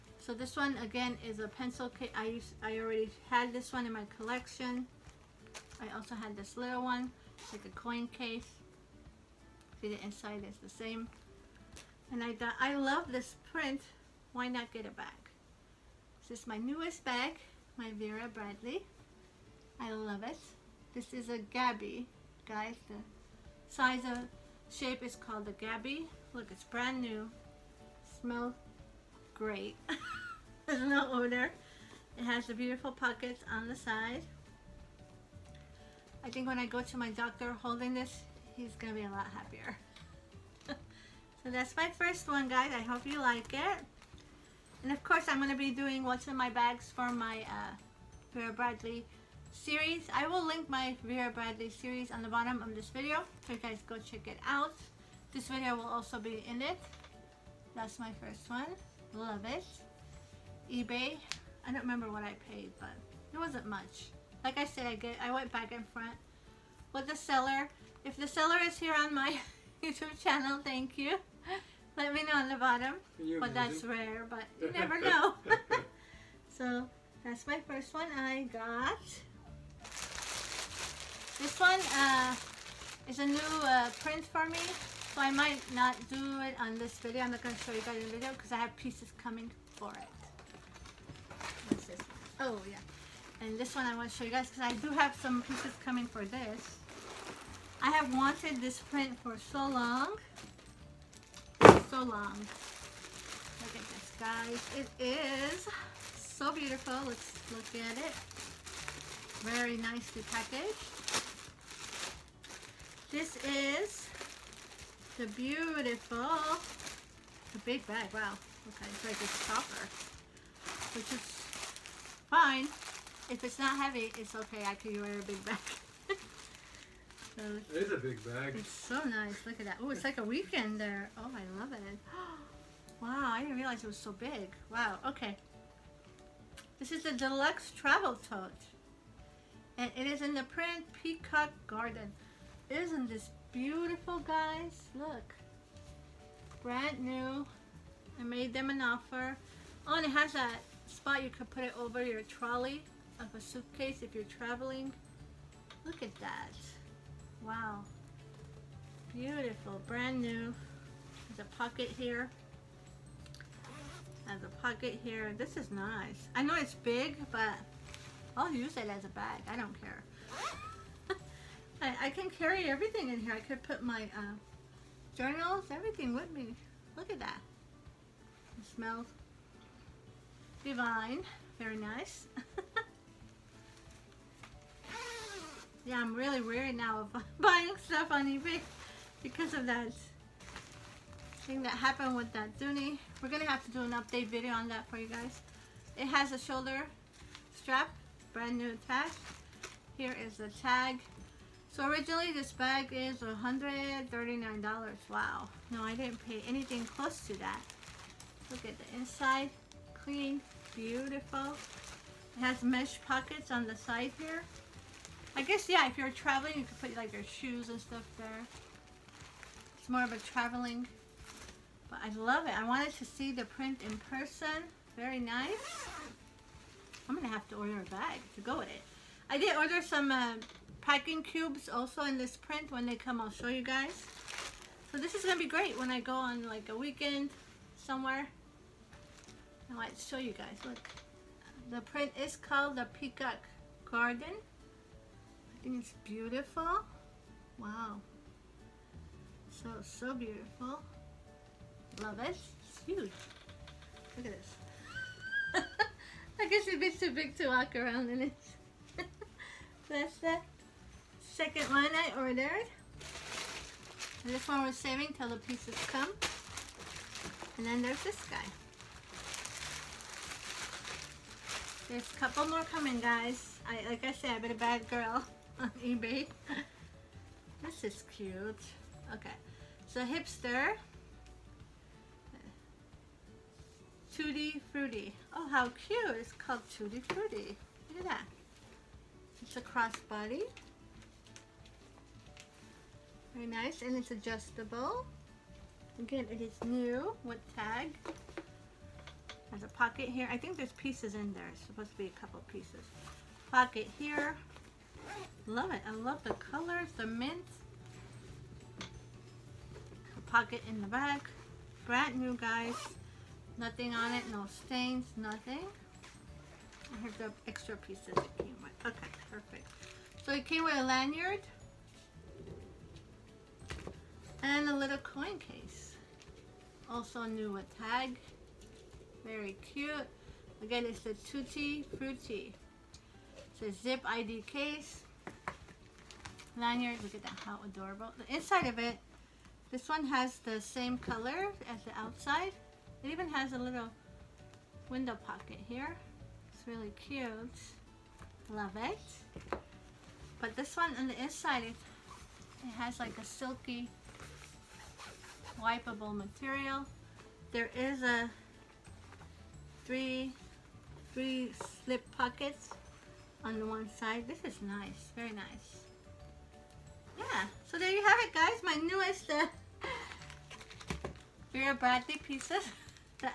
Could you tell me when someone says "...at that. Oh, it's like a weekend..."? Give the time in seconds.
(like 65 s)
129 s.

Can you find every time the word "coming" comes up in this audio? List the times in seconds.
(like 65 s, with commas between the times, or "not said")
89 s, 95 s, 272 s.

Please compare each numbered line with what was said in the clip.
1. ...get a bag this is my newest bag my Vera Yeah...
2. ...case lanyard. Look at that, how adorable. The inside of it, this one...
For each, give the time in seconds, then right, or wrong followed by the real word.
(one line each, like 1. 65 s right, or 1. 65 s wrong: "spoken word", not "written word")
1. 14 s wrong: "Bradley", not "Yeah"
2. 334 s right.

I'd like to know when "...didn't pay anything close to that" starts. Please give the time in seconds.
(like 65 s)
205 s.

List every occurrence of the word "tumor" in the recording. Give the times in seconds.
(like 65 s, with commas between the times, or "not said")
not said.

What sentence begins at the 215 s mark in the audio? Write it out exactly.
I guess, yeah, if you're traveling, you could put like your shoes and stuff there.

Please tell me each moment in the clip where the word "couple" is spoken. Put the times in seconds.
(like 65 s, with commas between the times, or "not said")
272 s, 302 s.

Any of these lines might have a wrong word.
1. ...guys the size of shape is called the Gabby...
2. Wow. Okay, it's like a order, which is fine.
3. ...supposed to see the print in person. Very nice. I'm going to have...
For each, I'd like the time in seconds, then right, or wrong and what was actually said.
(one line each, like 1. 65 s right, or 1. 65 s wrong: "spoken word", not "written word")
1. 22 s right
2. 118 s wrong: "stopper", not "order"
3. 222 s wrong: "wanted", not "supposed".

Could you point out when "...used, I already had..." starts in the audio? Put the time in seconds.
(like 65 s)
2 s.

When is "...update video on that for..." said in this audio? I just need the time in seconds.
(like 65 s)
193 s.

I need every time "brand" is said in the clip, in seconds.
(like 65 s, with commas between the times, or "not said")
26 s, 146 s, 159 s, 198 s, 311 s.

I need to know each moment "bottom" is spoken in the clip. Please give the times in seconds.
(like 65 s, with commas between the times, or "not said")
52 s, 72 s.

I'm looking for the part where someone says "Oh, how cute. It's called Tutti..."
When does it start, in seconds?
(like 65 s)
285 s.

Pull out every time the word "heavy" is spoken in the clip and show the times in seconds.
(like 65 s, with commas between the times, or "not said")
123 s.